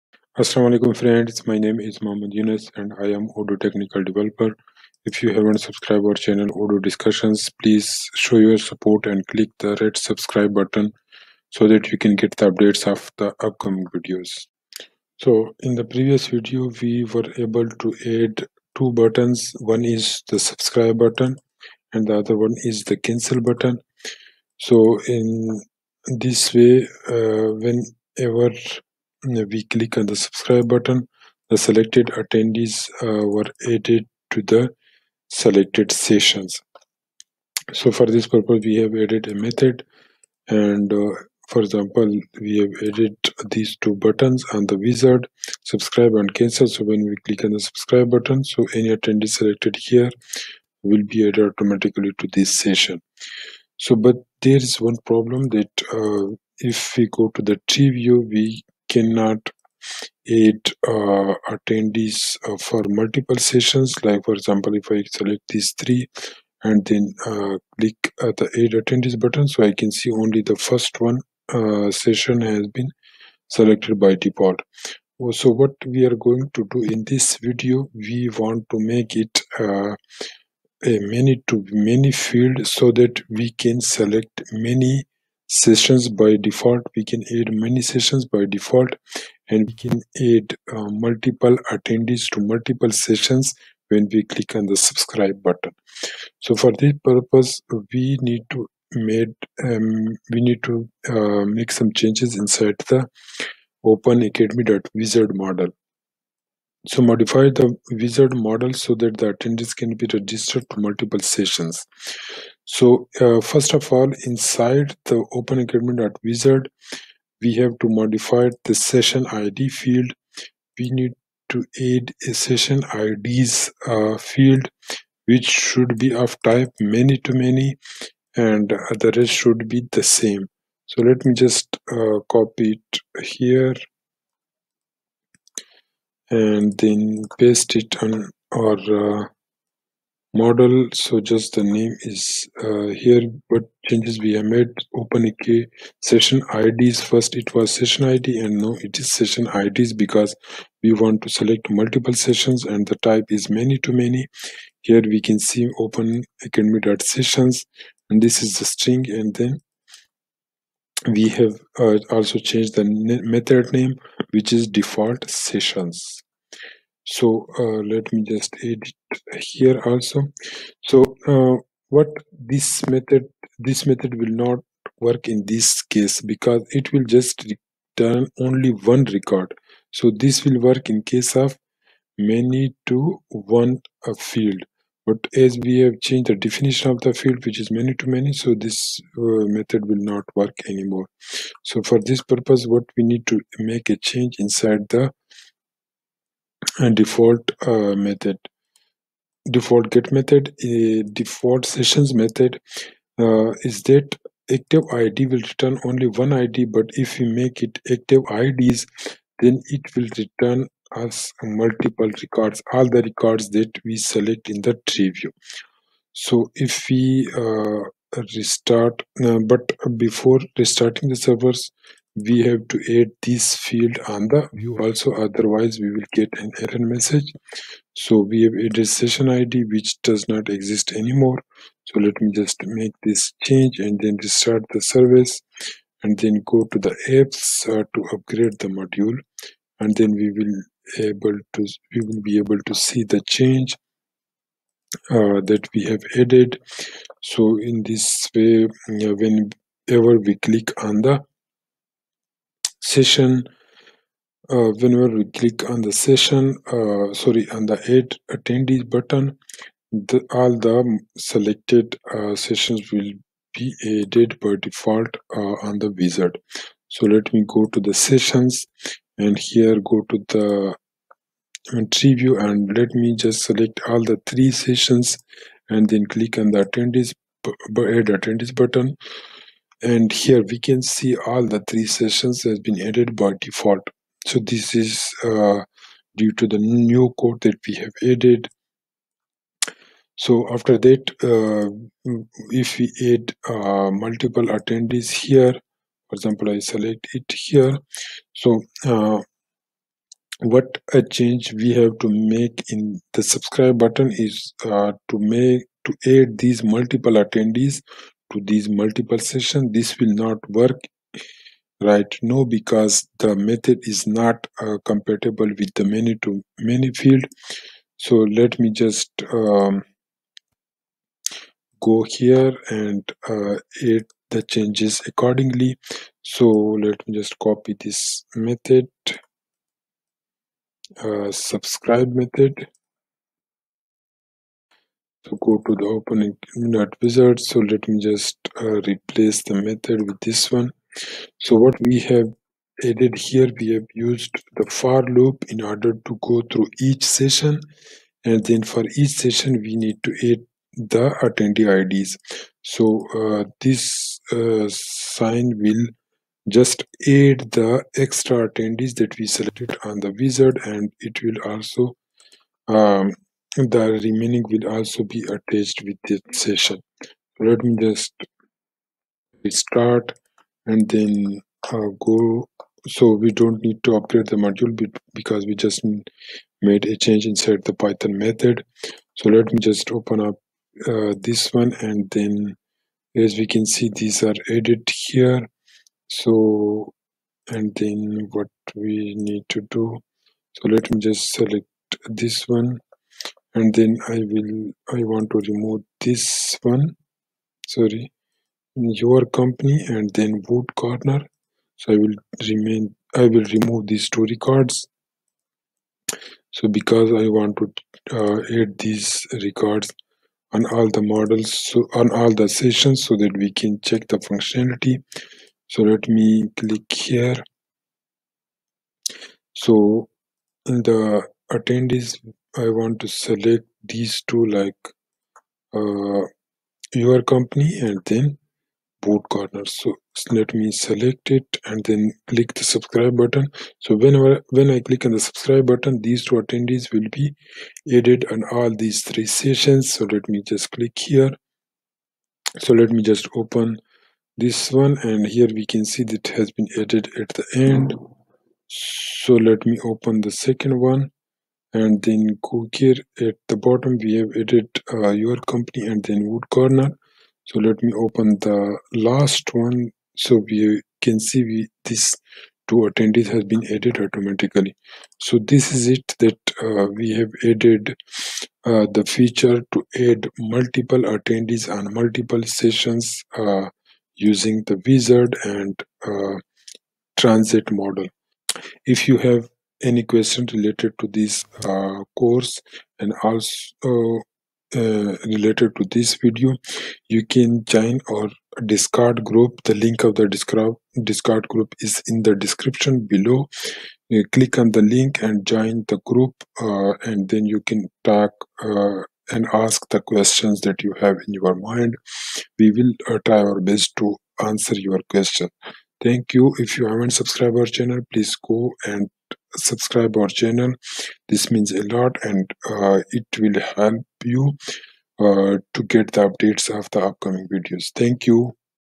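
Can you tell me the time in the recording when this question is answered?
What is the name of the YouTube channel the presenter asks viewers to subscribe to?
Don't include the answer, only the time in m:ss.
0:06.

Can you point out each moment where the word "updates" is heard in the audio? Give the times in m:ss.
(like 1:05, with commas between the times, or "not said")
0:12, 8:36.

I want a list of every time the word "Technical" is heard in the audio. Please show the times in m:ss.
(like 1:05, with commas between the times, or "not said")
0:03.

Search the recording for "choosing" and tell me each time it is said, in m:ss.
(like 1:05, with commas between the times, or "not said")
not said.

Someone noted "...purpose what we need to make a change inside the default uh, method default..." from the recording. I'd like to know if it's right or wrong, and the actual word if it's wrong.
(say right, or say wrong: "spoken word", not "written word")
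right.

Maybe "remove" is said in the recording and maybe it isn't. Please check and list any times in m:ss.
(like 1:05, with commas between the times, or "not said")
6:35, 6:43.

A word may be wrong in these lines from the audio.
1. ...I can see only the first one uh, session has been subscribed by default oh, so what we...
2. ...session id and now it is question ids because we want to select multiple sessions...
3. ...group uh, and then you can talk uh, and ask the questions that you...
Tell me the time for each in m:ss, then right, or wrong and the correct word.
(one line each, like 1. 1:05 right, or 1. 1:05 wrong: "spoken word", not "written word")
1. 1:09 wrong: "selected", not "subscribed"
2. 2:27 wrong: "session", not "question"
3. 8:16 right.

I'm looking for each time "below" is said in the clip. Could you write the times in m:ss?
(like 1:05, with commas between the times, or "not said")
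8:13.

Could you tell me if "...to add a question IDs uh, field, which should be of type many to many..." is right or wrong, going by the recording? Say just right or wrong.
wrong.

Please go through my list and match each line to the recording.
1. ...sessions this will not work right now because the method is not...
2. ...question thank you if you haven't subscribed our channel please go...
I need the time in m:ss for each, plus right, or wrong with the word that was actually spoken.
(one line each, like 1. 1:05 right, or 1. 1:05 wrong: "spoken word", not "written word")
1. 5:09 right
2. 8:25 right.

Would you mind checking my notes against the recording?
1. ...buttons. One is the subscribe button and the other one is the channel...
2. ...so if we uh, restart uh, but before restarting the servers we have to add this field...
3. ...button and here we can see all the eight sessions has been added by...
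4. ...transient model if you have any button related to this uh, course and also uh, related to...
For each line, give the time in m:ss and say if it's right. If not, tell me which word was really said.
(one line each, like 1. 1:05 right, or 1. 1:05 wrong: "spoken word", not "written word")
1. 0:18 wrong: "cancel", not "channel"
2. 3:36 right
3. 4:38 wrong: "three", not "eight"
4. 7:57 wrong: "question", not "button".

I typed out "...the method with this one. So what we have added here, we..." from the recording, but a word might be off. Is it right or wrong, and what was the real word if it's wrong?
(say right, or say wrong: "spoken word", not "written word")
right.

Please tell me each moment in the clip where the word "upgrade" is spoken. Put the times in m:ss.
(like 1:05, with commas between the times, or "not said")
3:58, 6:13.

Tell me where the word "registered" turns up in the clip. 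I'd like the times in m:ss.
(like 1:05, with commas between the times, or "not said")
1:50.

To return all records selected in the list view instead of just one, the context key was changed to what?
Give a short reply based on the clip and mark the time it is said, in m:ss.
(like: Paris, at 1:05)
active ids, at 3:27.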